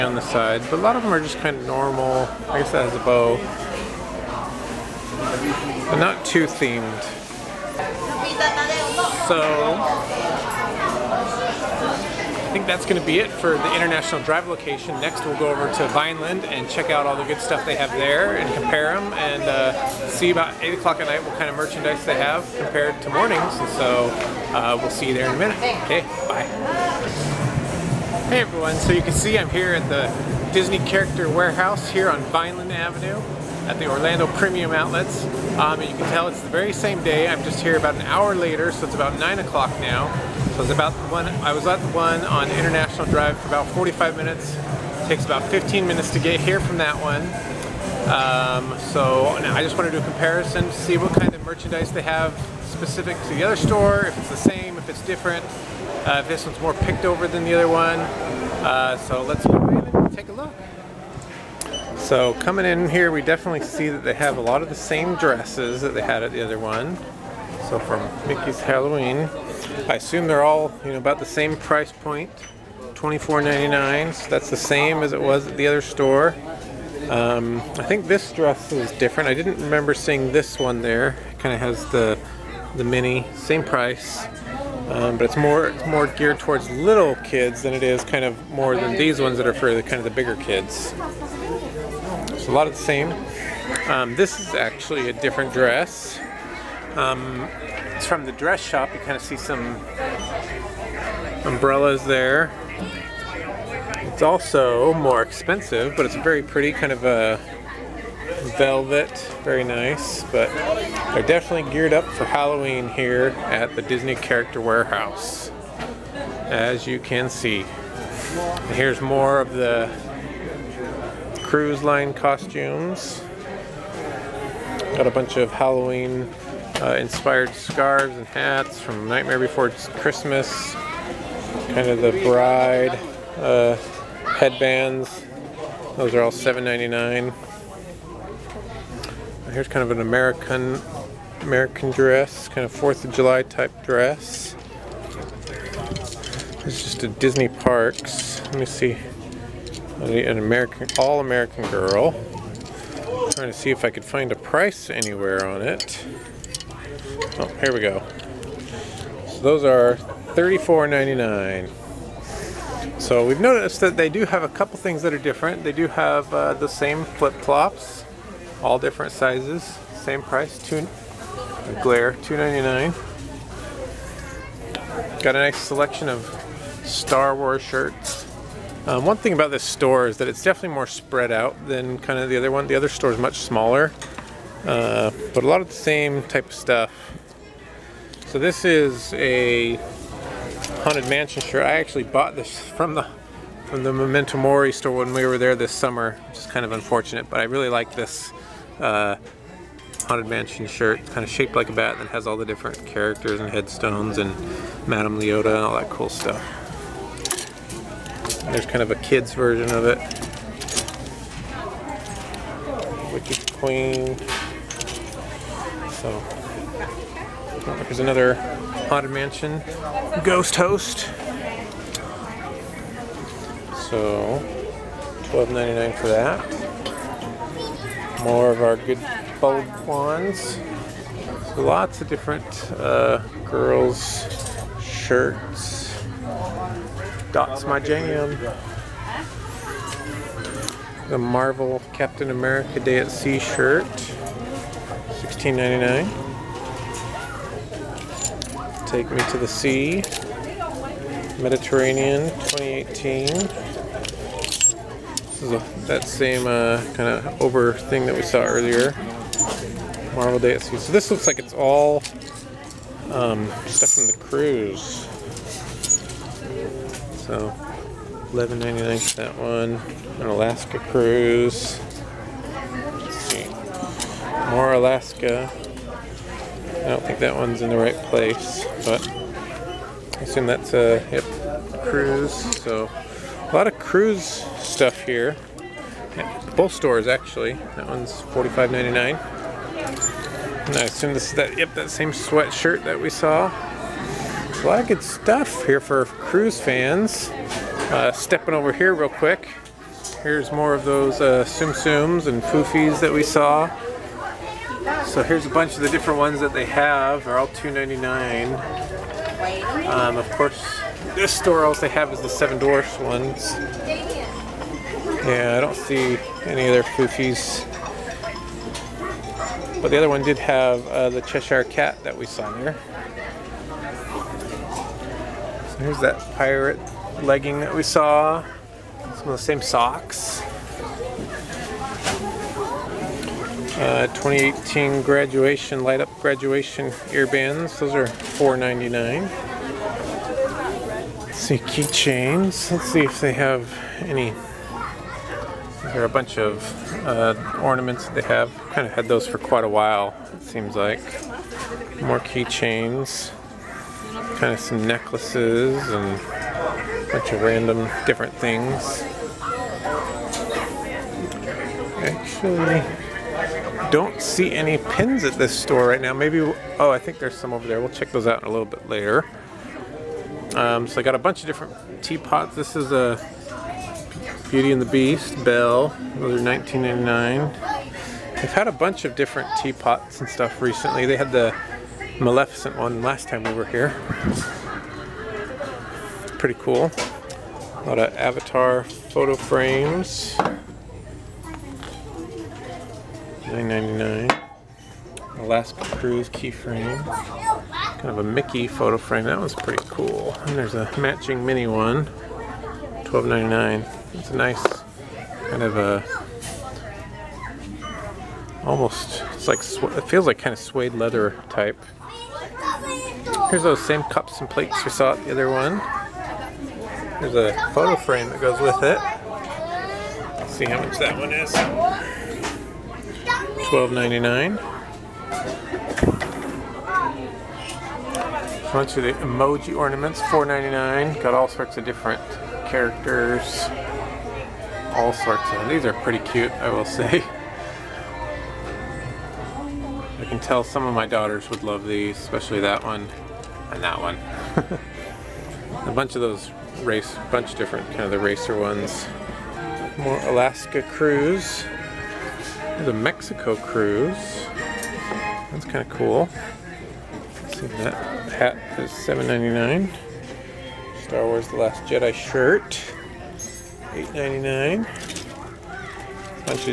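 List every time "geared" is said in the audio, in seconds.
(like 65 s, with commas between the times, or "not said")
86 s, 111 s.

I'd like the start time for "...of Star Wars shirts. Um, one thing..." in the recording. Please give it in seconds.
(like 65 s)
176 s.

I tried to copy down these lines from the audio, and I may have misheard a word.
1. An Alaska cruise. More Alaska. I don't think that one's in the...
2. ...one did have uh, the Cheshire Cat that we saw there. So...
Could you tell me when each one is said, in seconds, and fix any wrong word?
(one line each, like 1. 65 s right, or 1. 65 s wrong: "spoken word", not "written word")
1. 270 s right
2. 320 s right.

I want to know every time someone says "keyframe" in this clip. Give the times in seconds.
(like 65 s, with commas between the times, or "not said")
396 s.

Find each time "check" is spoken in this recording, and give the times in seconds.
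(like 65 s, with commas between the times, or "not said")
16 s, 367 s.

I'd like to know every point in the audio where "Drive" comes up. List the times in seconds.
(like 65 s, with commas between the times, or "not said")
14 s, 43 s.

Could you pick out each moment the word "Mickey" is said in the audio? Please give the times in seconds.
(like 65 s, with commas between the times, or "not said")
68 s, 398 s.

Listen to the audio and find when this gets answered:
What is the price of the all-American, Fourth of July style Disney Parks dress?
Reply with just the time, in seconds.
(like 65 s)
160 s.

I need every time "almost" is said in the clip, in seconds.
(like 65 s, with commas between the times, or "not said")
408 s.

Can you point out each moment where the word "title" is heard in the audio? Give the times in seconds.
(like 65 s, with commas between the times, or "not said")
not said.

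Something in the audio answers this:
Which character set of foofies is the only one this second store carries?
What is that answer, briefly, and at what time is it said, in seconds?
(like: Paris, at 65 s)
Seven Dwarfs, at 312 s.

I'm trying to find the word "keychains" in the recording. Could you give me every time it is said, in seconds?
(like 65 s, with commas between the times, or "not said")
341 s, 352 s.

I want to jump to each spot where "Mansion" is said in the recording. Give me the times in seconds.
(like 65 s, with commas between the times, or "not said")
191 s, 200 s, 219 s.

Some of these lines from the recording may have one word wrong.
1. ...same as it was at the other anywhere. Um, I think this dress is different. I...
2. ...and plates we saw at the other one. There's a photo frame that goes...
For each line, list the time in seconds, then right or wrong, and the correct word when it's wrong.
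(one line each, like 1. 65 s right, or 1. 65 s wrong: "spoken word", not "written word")
1. 74 s wrong: "store", not "anywhere"
2. 414 s right.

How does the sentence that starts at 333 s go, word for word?
Uh, 2018 graduation, light up graduation earbands.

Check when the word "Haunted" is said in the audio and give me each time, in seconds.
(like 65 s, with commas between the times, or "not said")
190 s, 200 s, 218 s.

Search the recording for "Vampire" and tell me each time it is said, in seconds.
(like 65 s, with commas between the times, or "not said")
not said.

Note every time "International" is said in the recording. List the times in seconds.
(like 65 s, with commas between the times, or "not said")
13 s, 42 s.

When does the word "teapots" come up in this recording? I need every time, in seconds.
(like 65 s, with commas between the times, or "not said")
372 s, 379 s.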